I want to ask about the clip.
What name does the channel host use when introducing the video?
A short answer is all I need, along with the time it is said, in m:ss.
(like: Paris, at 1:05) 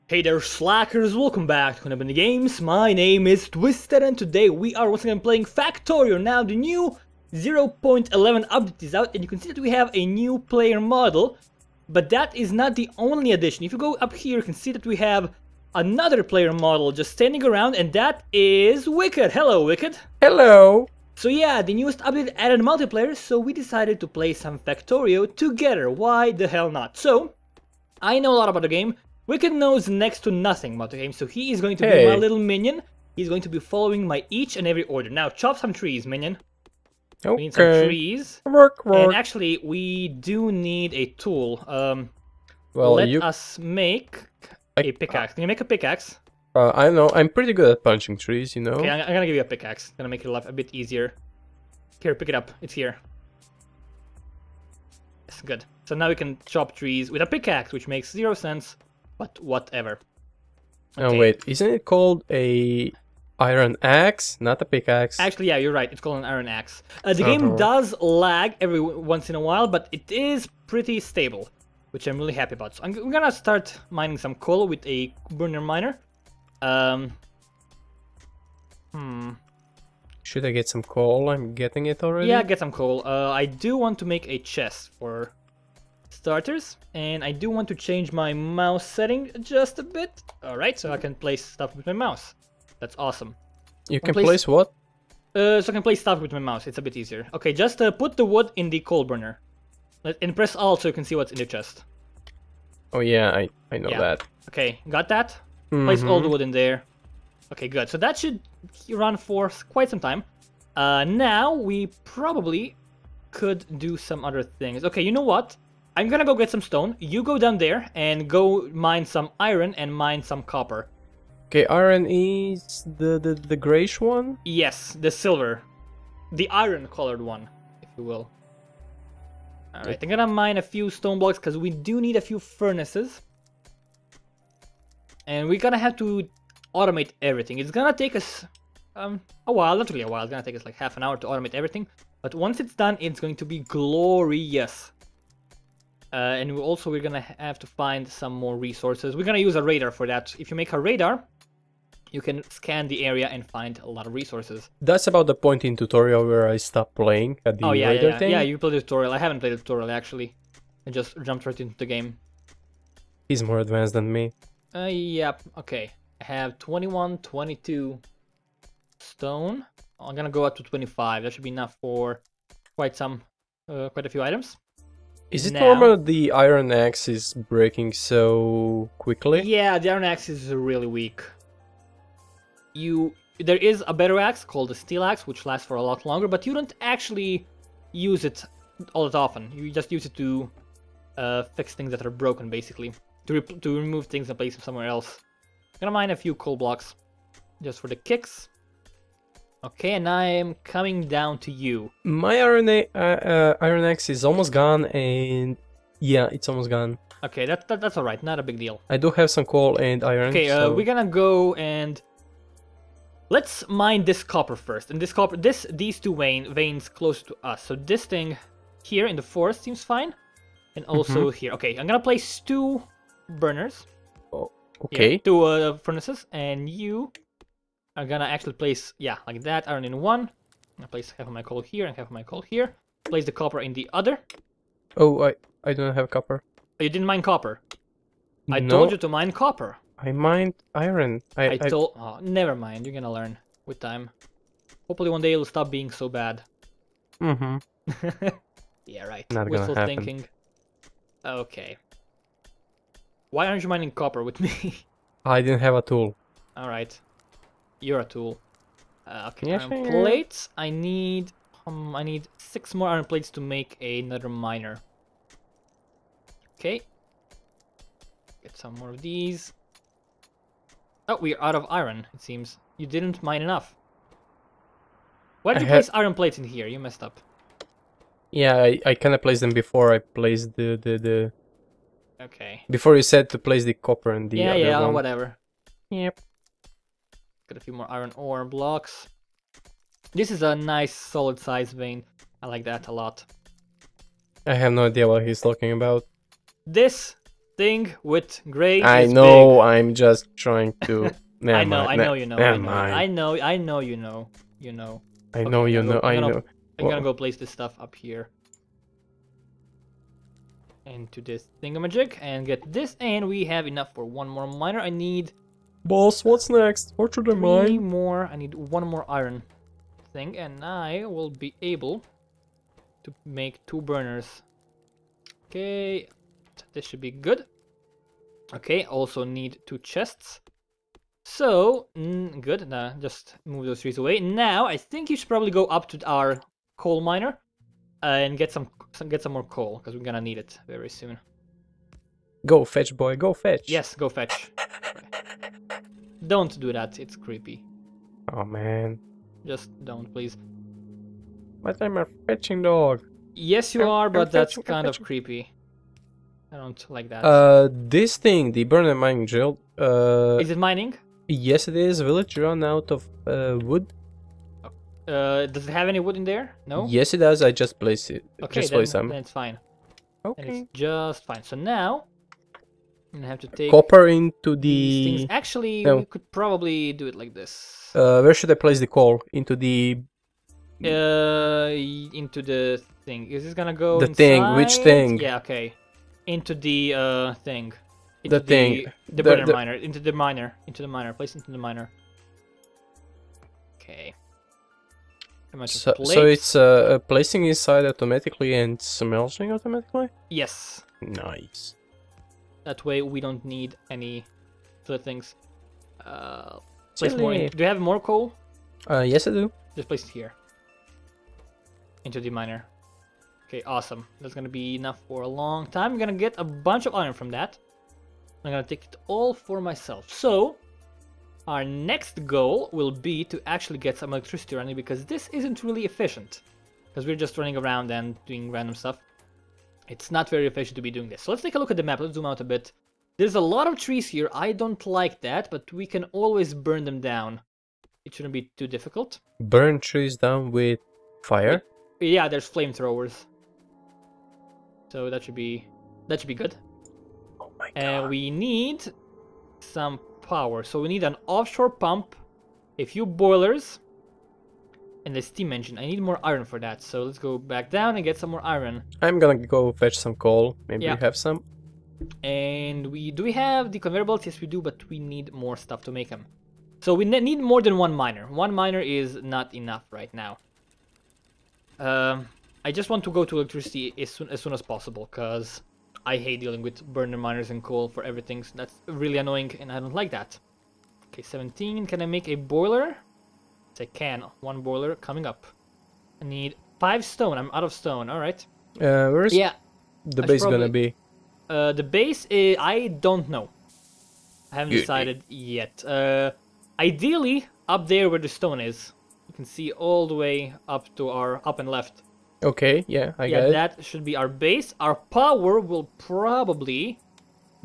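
Twisted, at 0:03.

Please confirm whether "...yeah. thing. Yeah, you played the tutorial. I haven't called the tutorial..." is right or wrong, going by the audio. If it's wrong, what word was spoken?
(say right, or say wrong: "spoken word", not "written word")
wrong: "played", not "called".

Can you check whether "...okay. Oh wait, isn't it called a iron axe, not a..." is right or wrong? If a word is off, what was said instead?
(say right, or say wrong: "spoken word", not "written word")
right.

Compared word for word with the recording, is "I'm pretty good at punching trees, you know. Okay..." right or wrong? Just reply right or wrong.
right.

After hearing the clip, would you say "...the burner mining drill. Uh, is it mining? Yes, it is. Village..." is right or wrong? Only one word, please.
right.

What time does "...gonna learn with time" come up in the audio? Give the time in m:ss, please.
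4:02.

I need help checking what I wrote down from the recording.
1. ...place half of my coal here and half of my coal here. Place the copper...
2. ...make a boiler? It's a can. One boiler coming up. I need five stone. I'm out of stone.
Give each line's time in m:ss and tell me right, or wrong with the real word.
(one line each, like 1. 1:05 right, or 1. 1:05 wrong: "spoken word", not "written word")
1. 3:50 right
2. 8:02 right.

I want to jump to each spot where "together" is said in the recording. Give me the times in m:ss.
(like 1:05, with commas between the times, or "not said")
0:25.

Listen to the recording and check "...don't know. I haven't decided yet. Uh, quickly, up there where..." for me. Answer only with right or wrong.
wrong.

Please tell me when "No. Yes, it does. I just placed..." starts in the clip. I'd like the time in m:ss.
6:06.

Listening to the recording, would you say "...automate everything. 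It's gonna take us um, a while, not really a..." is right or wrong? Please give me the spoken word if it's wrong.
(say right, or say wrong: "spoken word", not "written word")
right.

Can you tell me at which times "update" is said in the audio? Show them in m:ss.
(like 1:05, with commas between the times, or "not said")
0:08, 0:22.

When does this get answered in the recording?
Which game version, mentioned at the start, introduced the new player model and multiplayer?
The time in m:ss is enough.
0:07.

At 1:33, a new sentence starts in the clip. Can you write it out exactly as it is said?
You can, can place, place, what?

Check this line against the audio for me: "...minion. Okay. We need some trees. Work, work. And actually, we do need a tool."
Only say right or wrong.
right.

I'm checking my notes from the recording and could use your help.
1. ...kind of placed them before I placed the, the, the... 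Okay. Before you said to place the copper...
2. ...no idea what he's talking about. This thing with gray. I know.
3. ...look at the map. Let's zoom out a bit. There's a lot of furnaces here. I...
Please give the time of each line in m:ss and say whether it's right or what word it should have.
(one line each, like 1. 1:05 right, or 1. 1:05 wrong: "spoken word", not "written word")
1. 4:38 right
2. 4:54 right
3. 7:11 wrong: "trees", not "furnaces".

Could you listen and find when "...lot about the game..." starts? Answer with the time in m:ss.
0:28.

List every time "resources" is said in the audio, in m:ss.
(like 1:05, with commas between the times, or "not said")
2:28, 2:34.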